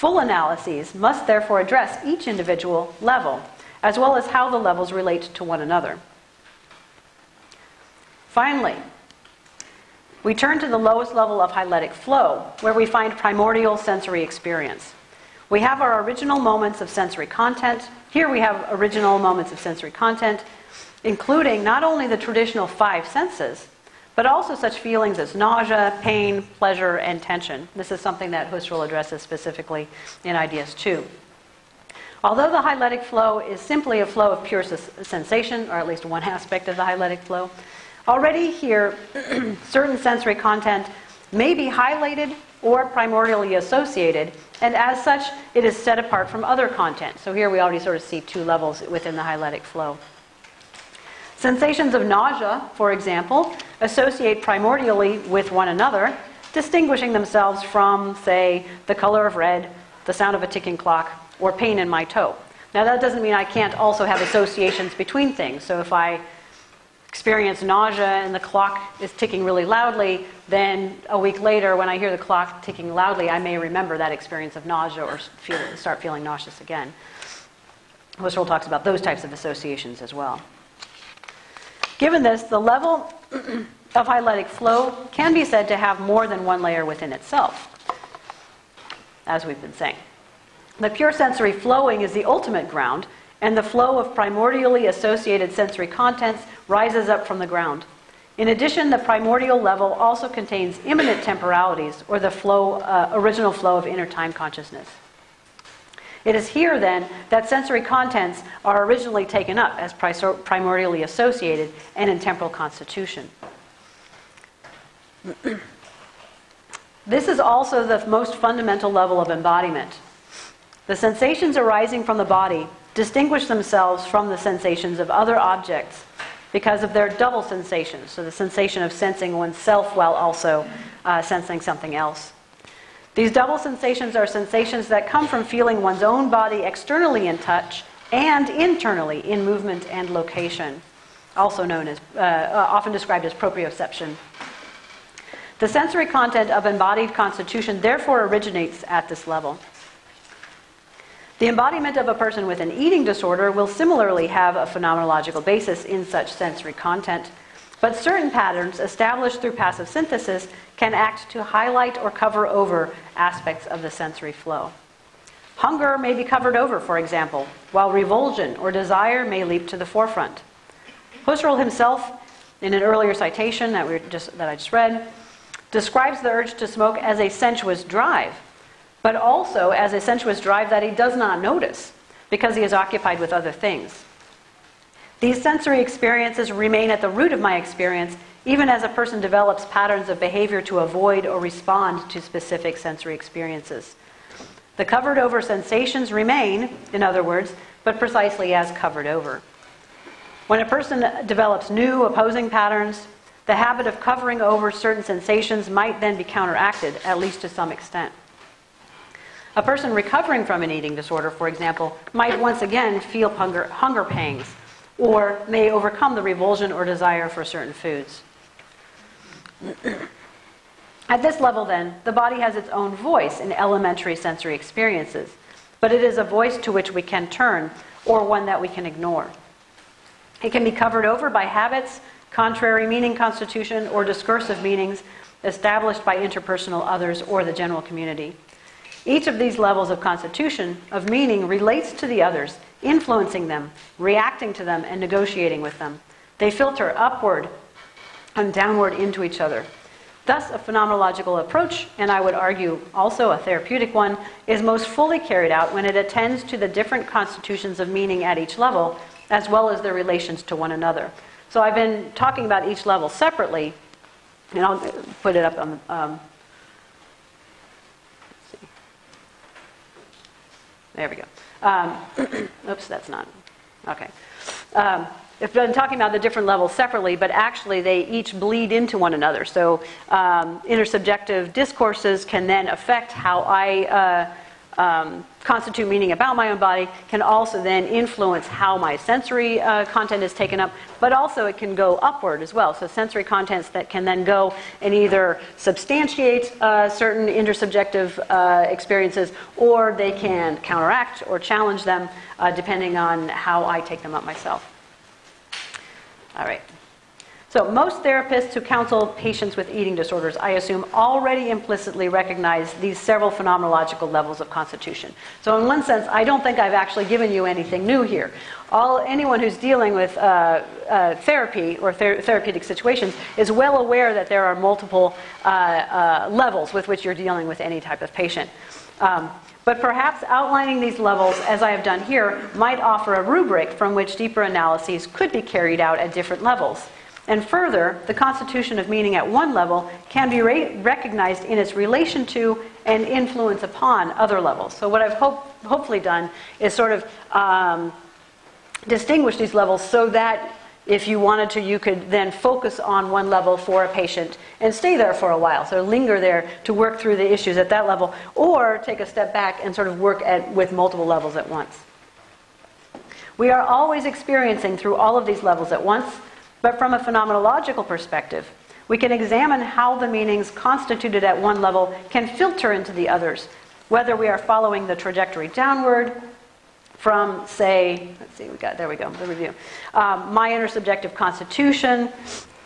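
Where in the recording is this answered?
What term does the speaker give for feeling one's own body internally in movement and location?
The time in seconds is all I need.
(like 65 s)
143 s.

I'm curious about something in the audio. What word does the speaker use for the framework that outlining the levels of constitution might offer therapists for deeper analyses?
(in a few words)
rubric.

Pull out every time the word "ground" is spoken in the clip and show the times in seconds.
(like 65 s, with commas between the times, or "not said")
92 s, 97 s.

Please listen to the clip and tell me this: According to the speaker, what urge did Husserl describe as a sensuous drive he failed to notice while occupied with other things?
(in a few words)
the urge to smoke.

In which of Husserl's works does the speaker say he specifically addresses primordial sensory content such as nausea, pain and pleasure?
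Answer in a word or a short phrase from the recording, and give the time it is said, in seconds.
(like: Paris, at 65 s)
Ideas 2, at 30 s.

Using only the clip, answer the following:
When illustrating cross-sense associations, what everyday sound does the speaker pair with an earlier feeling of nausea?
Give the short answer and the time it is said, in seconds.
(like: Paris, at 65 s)
a ticking clock, at 60 s.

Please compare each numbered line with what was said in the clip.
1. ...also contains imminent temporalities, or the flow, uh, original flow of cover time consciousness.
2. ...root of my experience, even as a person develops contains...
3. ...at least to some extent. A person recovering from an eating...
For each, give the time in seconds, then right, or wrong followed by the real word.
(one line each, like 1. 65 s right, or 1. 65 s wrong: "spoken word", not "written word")
1. 99 s wrong: "inner", not "cover"
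2. 187 s wrong: "patterns", not "contains"
3. 207 s right.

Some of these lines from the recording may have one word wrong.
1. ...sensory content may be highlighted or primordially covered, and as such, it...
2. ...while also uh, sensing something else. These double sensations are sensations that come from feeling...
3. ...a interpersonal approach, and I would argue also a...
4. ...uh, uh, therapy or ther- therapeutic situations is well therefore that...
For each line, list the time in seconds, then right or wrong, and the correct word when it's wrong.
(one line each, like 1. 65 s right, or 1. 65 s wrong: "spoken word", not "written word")
1. 39 s wrong: "associated", not "covered"
2. 129 s right
3. 250 s wrong: "phenomenological", not "interpersonal"
4. 320 s wrong: "aware", not "therefore".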